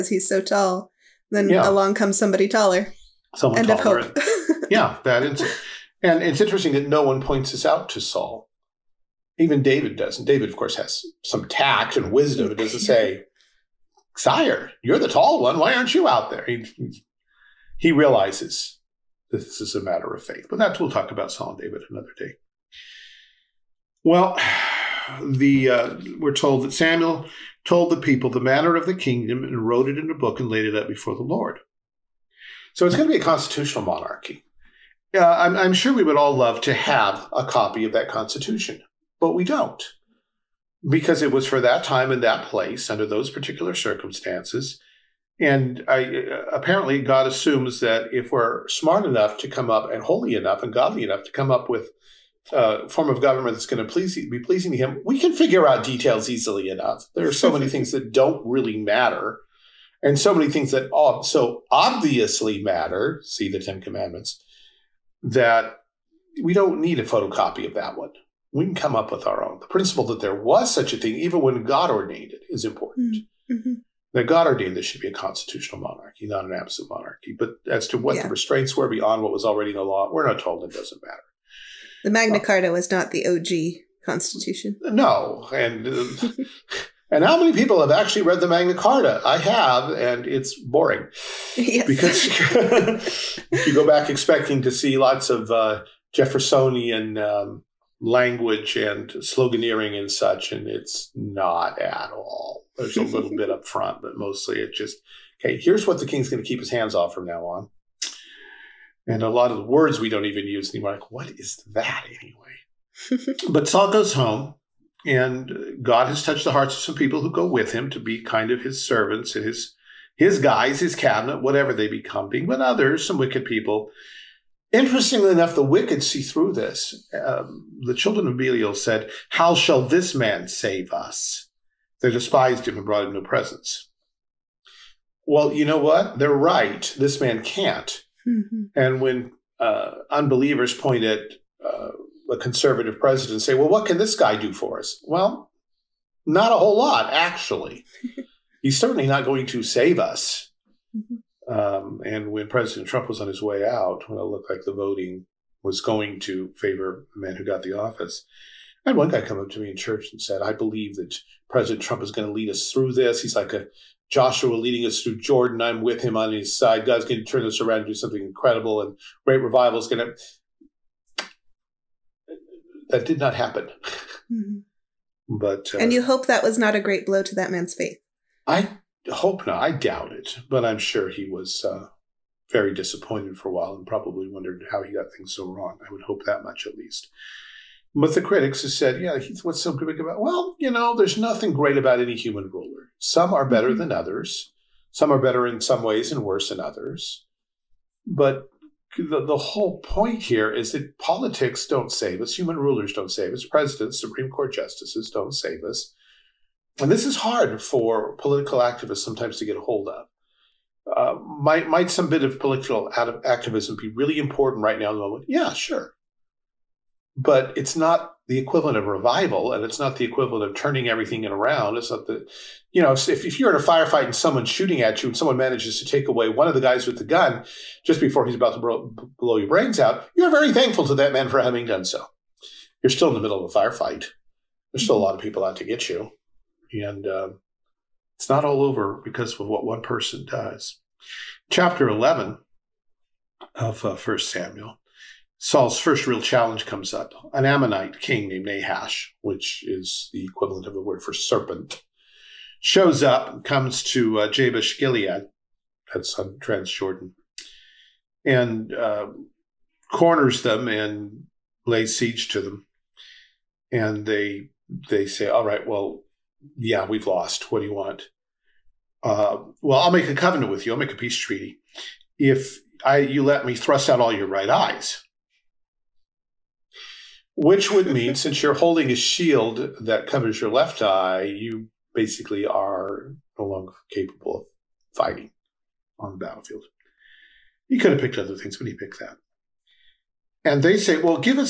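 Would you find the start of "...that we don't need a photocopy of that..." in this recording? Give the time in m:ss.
1:05.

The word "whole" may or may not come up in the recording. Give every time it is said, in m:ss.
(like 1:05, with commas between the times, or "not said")
2:26, 3:19.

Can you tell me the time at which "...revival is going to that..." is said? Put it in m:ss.
2:49.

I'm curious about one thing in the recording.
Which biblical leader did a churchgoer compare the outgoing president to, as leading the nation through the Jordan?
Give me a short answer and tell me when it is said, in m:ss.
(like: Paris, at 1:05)
Joshua, at 2:44.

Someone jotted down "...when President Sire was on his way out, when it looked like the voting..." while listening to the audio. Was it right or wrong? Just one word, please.
wrong.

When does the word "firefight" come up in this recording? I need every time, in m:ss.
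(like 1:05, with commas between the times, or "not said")
3:43, 3:53.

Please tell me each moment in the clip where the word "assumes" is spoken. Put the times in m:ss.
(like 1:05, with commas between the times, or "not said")
0:47.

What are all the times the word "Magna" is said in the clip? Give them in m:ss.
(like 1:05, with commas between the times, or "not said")
1:22, 1:28.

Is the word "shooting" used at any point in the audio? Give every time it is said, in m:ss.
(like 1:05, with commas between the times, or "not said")
3:44.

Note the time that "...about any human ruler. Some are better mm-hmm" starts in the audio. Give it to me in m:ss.
3:11.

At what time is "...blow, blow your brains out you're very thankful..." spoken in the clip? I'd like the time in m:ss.
3:48.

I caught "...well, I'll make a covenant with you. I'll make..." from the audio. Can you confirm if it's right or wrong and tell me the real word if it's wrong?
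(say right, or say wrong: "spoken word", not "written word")
right.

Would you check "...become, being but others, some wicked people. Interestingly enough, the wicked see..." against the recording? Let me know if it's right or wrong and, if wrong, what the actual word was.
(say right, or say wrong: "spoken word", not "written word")
right.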